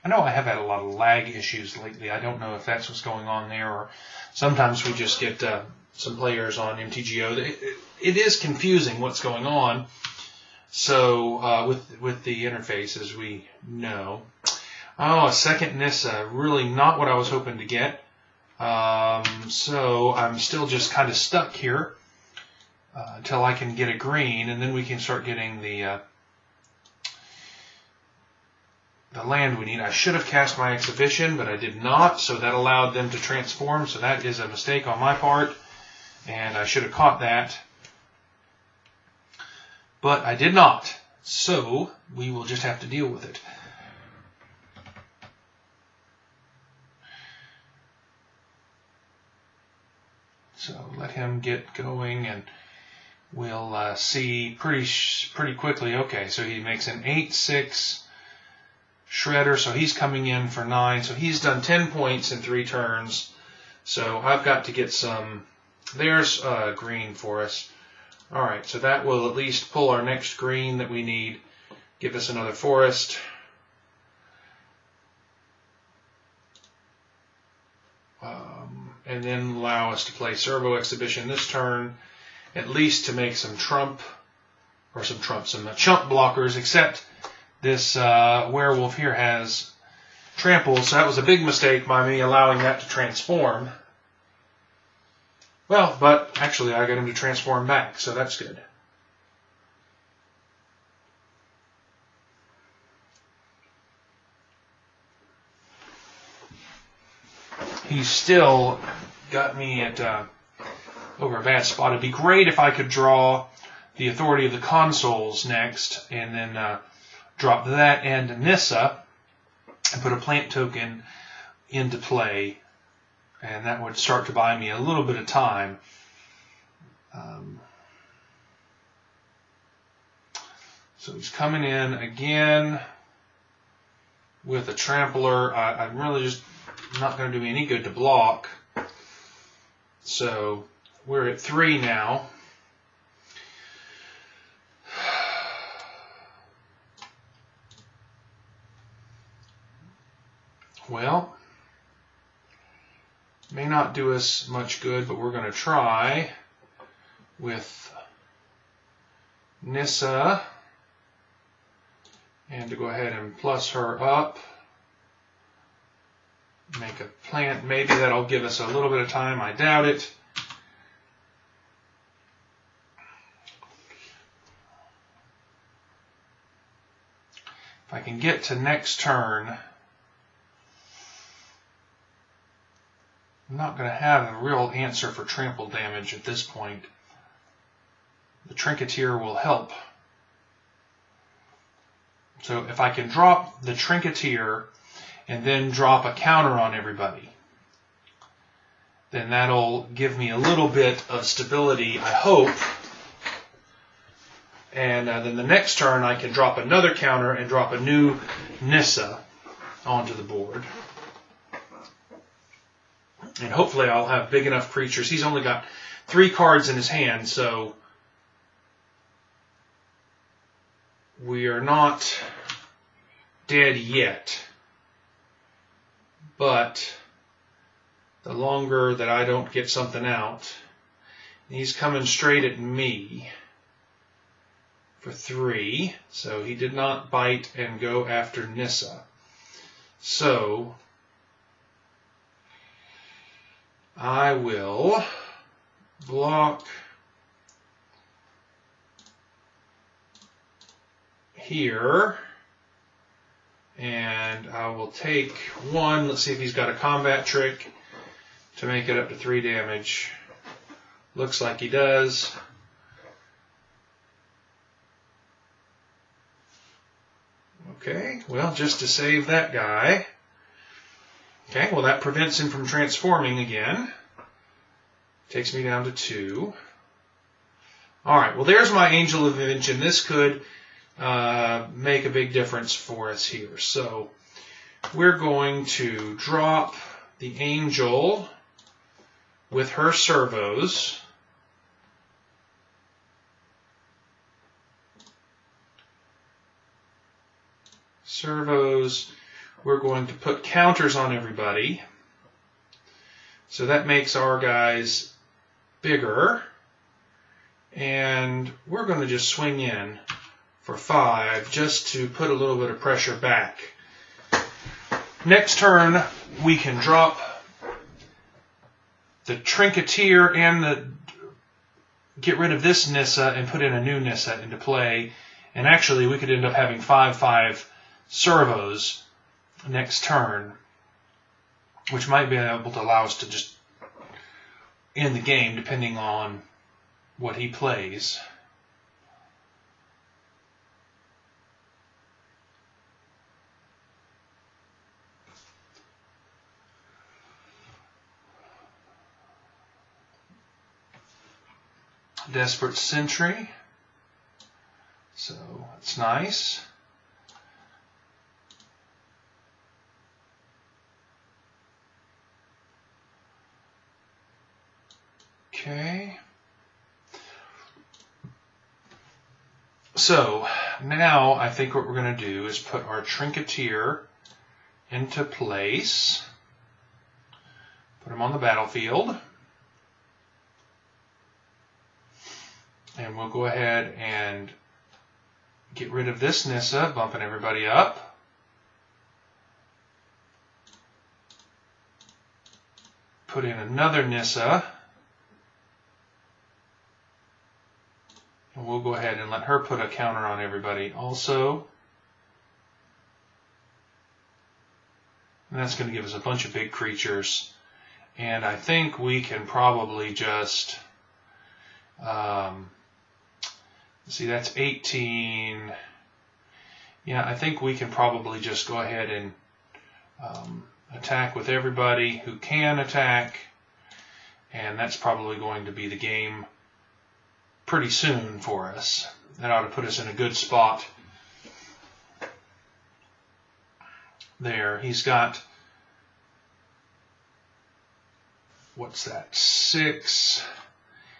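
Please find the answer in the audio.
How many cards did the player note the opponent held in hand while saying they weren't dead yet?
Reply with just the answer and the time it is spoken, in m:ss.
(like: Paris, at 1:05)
3, at 3:36.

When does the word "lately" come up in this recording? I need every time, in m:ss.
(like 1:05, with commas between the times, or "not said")
0:01.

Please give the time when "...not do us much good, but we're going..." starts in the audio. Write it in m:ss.
2:33.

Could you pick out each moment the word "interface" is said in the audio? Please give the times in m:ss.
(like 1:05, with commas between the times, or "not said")
0:12.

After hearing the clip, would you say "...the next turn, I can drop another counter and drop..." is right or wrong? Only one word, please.
right.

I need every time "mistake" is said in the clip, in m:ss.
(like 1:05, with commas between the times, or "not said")
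0:34, 1:31.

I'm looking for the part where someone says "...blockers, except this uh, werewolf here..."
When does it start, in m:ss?
1:26.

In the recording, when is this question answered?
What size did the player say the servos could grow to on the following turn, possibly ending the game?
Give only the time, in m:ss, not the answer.
5:26.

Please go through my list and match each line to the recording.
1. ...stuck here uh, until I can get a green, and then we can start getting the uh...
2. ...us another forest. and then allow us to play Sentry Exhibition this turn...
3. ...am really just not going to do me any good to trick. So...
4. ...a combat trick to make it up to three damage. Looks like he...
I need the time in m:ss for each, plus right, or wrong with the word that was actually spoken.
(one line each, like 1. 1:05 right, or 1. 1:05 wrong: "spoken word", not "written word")
1. 0:21 right
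2. 1:12 wrong: "Servo", not "Sentry"
3. 2:15 wrong: "block", not "trick"
4. 4:16 right.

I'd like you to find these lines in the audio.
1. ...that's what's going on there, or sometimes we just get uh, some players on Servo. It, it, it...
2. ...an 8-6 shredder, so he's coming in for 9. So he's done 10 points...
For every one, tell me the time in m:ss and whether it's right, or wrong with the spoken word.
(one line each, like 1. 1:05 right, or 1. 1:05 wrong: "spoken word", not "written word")
1. 0:02 wrong: "MTGO", not "Servo"
2. 0:56 right.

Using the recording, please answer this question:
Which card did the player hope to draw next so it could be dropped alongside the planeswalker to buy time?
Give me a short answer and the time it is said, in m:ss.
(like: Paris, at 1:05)
Authority of the Consuls, at 1:54.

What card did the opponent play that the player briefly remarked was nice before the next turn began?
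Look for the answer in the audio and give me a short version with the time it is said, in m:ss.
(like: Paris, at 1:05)
Desperate Sentry, at 5:52.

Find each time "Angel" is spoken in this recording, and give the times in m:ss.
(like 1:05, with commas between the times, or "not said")
4:38, 4:47.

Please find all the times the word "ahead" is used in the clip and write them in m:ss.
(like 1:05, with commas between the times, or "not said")
2:42, 6:23, 6:38, 6:58.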